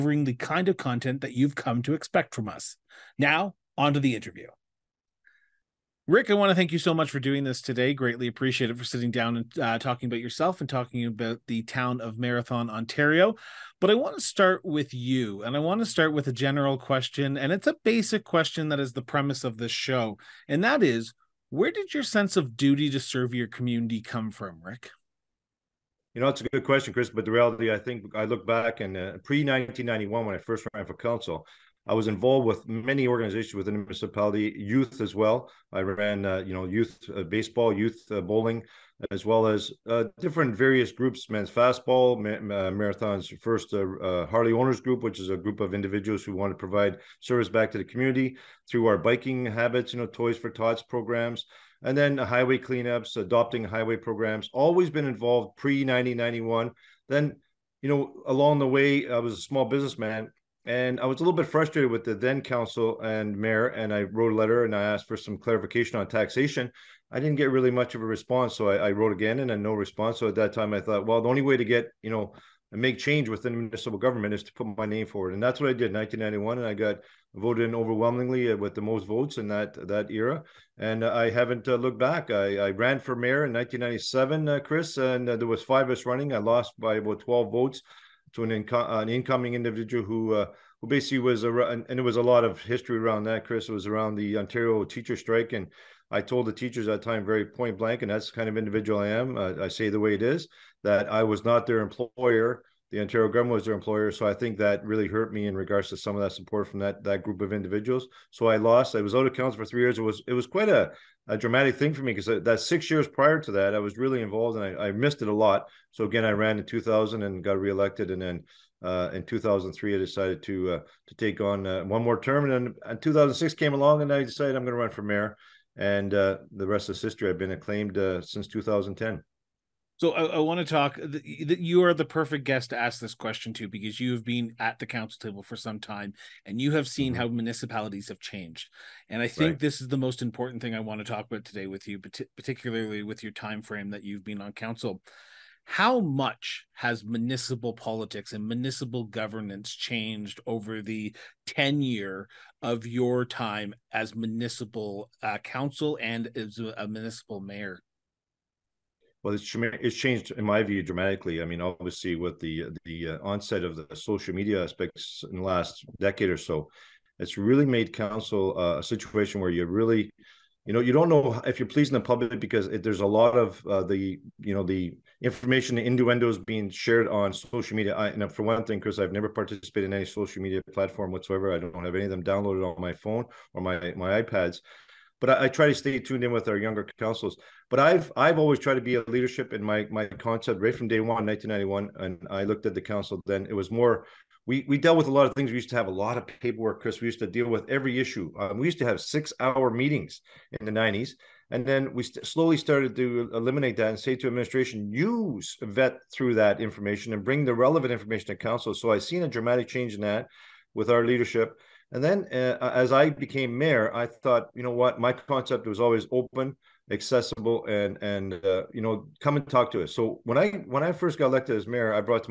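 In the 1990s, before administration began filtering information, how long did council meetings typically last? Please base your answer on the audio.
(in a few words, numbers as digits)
6 hours.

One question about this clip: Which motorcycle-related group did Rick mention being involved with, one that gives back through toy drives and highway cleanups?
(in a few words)
Harley Owners Group.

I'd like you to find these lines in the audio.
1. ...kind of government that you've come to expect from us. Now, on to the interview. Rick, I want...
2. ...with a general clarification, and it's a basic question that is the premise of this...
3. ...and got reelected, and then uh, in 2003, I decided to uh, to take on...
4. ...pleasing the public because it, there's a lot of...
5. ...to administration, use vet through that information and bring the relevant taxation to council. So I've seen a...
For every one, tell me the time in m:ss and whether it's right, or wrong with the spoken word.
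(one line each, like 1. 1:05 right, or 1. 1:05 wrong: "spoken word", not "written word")
1. 0:00 wrong: "content", not "government"
2. 0:16 wrong: "question", not "clarification"
3. 1:57 right
4. 2:51 right
5. 3:24 wrong: "information", not "taxation".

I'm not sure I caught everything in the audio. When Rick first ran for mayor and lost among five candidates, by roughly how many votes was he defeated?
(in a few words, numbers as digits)
12.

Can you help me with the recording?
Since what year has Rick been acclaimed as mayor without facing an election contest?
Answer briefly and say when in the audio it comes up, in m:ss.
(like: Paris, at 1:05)
2010, at 2:08.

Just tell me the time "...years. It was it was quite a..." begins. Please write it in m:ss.
1:49.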